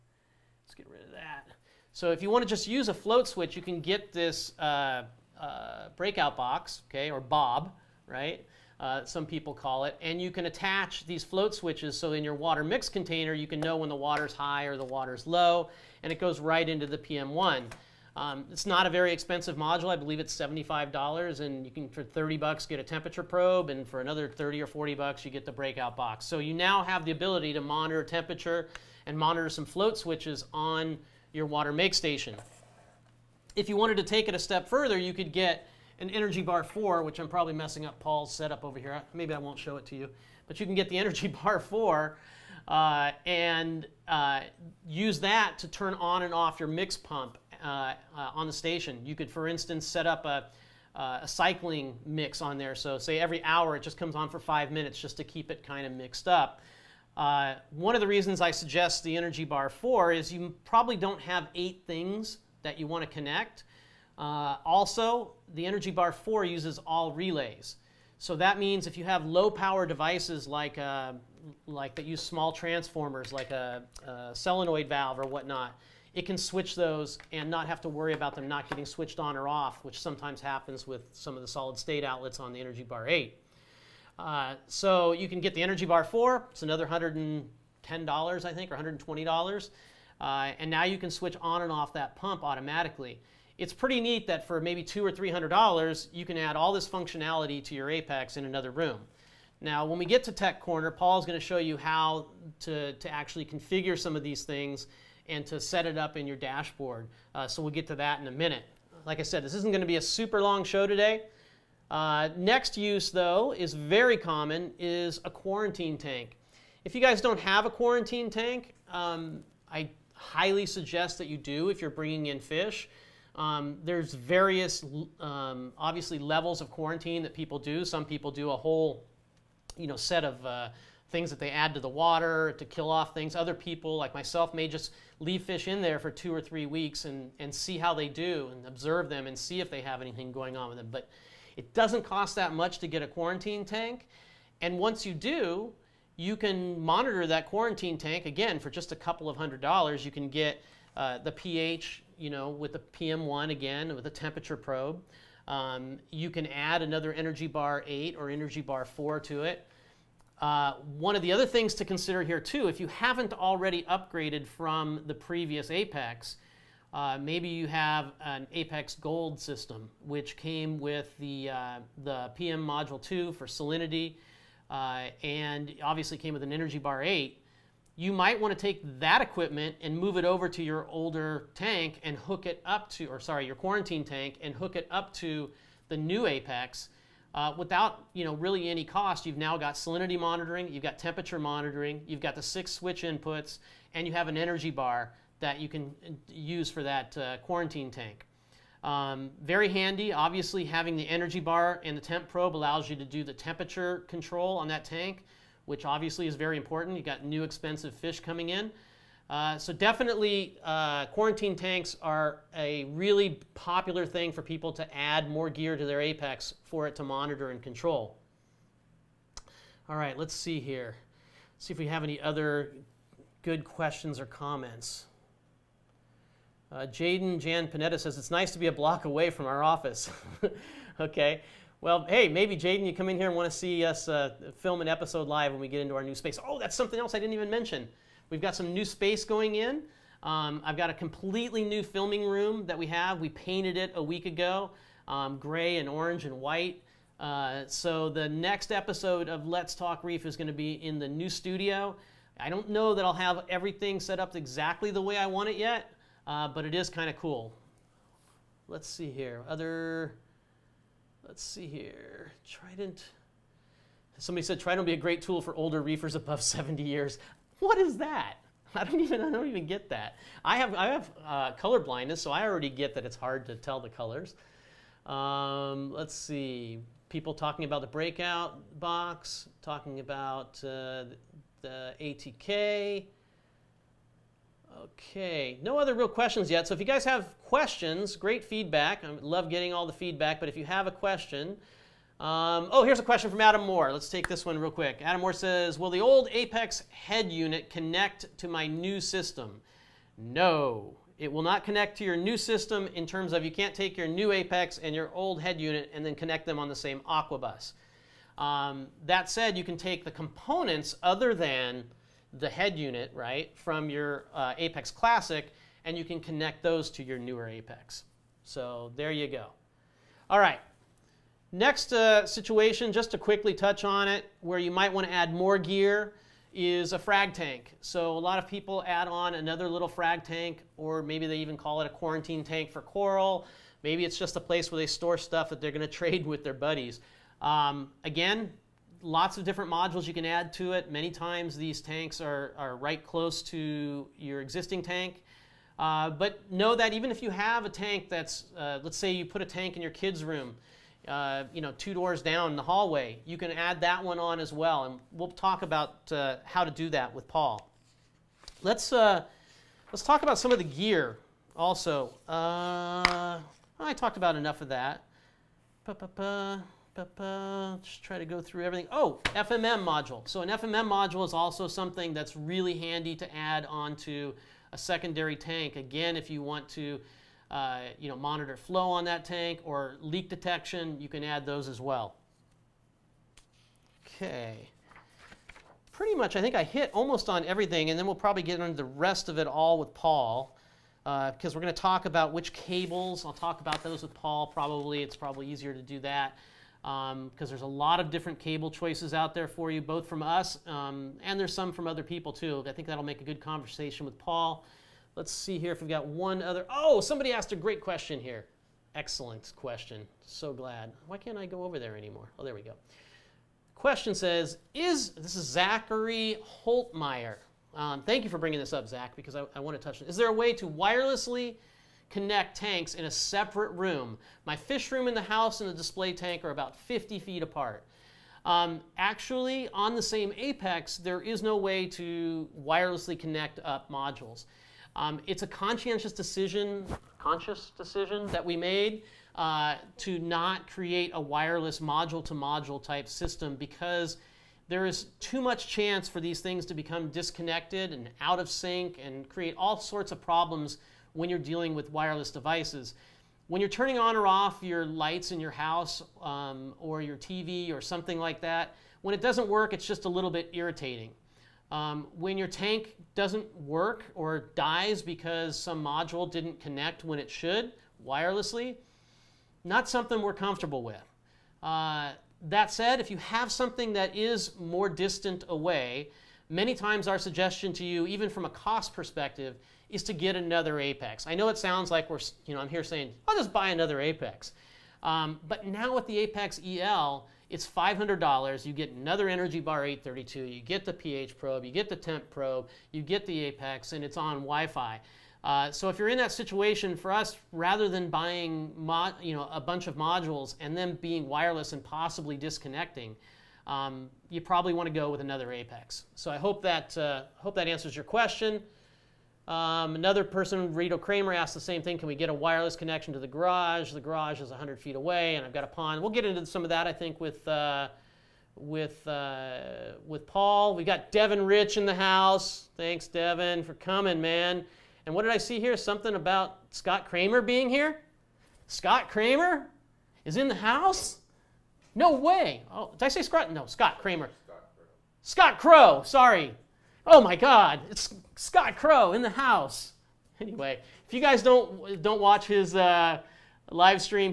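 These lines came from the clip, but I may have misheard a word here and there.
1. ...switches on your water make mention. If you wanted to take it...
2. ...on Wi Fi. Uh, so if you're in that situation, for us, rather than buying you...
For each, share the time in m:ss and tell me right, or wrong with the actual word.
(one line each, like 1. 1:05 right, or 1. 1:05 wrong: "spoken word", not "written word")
1. 0:29 wrong: "station", not "mention"
2. 8:14 right.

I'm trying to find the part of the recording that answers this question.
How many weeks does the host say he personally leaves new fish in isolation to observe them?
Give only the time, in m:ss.
2:16.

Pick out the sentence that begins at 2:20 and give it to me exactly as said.
But it doesn't cost that much to get a quarantine tank.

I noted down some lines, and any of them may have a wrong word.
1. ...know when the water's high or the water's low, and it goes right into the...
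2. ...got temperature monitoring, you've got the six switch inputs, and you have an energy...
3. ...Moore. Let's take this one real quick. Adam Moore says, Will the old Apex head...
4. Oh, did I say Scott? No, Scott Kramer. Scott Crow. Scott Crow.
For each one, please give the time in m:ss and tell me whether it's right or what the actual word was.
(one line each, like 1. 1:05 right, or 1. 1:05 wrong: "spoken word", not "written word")
1. 0:13 right
2. 3:10 right
3. 4:53 right
4. 8:52 right.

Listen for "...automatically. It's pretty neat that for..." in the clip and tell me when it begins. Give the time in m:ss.
1:32.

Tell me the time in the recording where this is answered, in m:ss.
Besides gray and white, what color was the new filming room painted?
4:05.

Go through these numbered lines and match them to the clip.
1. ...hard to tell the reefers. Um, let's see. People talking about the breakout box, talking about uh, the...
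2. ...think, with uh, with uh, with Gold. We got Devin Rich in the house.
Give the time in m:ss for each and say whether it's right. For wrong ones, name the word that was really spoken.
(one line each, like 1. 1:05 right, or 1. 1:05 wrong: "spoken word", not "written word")
1. 4:33 wrong: "colors", not "reefers"
2. 8:36 wrong: "Paul", not "Gold".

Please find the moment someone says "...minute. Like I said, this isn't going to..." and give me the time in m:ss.
1:48.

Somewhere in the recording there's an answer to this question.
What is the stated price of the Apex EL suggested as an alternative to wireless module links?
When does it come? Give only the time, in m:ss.
8:07.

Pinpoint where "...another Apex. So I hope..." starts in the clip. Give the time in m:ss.
8:25.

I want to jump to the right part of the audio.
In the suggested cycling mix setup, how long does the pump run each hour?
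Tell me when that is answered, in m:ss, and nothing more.
0:54.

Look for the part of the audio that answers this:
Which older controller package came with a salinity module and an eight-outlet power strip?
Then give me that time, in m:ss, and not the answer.
2:48.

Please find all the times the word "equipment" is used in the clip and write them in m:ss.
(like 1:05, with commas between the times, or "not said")
2:59.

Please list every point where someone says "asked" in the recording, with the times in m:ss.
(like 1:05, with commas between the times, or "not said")
6:47, 8:31.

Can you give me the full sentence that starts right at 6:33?
I'll talk about those with Paul probably.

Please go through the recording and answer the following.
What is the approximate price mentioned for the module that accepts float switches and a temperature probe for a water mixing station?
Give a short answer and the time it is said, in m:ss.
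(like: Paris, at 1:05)
$75, at 0:20.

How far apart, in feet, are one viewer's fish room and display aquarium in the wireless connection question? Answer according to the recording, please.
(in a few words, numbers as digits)
50 feet.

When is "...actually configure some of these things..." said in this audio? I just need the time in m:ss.
1:43.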